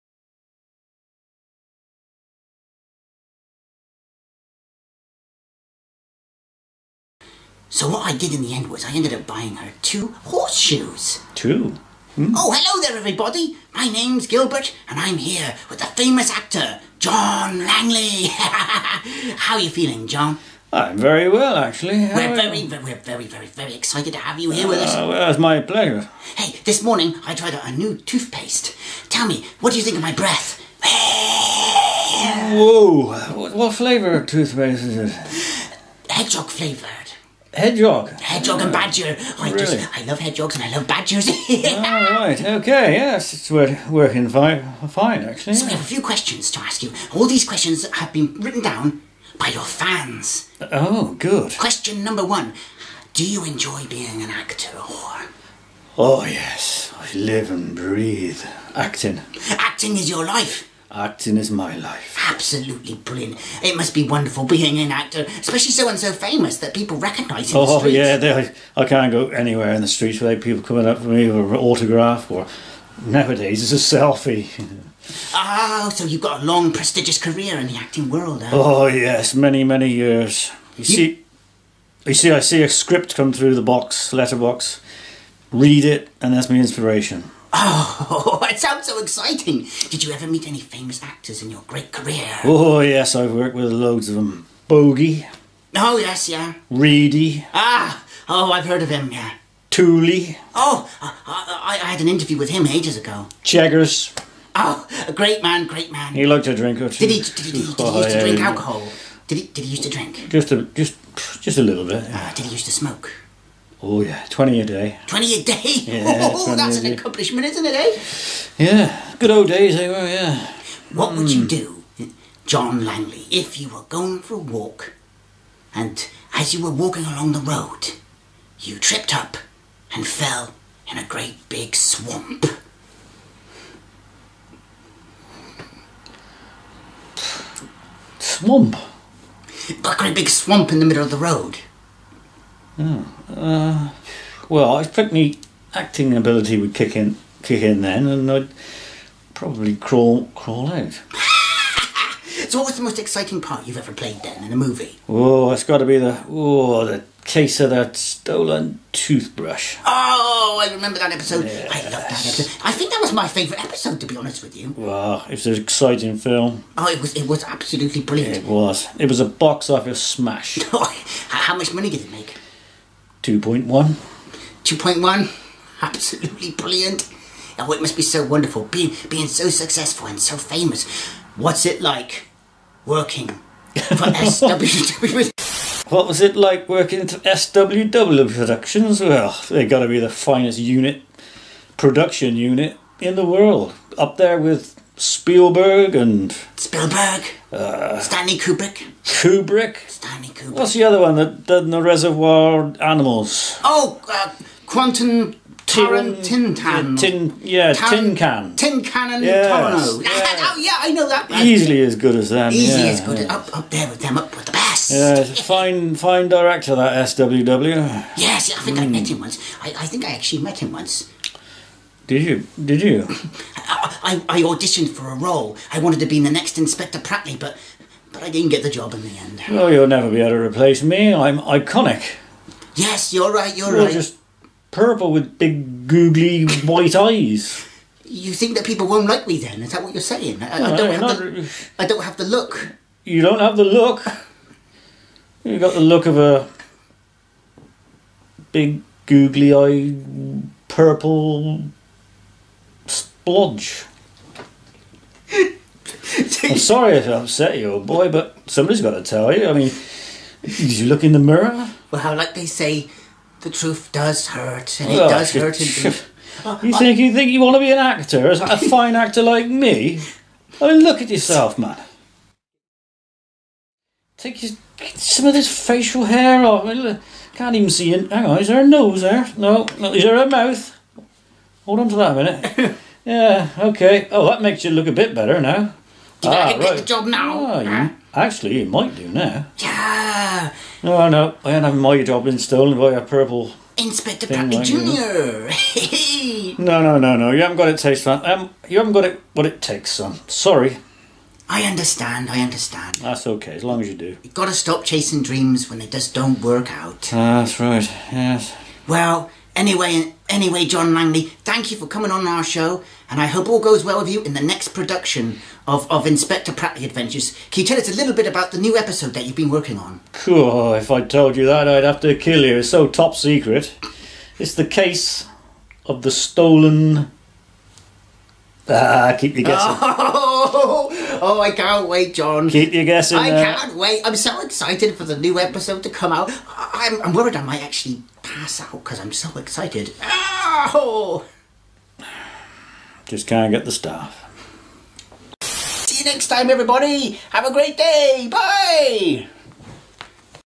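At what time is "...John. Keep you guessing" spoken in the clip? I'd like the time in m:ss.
5:32.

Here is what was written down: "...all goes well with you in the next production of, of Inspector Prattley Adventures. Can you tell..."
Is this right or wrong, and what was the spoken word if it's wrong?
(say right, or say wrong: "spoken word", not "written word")
right.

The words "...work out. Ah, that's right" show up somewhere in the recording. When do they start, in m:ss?
5:06.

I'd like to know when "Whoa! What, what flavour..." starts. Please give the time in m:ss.
0:32.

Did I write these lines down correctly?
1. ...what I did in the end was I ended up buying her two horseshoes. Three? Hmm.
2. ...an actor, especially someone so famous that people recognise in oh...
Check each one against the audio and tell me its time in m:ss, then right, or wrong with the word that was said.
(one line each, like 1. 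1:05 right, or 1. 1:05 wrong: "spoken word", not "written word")
1. 0:07 wrong: "Two", not "Three"
2. 1:04 right.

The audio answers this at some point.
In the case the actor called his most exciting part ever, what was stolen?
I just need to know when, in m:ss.
2:37.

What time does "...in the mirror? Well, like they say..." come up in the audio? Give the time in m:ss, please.
4:21.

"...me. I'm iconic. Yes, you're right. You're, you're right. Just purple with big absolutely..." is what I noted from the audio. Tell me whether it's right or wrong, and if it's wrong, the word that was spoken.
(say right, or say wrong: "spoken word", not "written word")
wrong: "googly", not "absolutely".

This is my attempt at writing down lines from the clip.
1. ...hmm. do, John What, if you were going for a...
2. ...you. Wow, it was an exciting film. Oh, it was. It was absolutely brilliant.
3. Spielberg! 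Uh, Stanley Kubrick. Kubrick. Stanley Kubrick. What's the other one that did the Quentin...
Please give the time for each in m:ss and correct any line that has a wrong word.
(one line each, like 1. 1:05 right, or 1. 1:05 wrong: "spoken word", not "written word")
1. 2:01 wrong: "Langley", not "What"
2. 2:44 right
3. 3:16 wrong: "Reservoir", not "Quentin".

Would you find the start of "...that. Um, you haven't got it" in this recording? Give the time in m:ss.
4:58.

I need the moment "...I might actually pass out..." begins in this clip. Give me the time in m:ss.
5:37.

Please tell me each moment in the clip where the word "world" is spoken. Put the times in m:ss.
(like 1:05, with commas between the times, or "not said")
1:18, 3:13.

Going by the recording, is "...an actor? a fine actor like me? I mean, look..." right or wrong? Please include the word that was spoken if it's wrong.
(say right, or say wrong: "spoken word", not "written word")
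right.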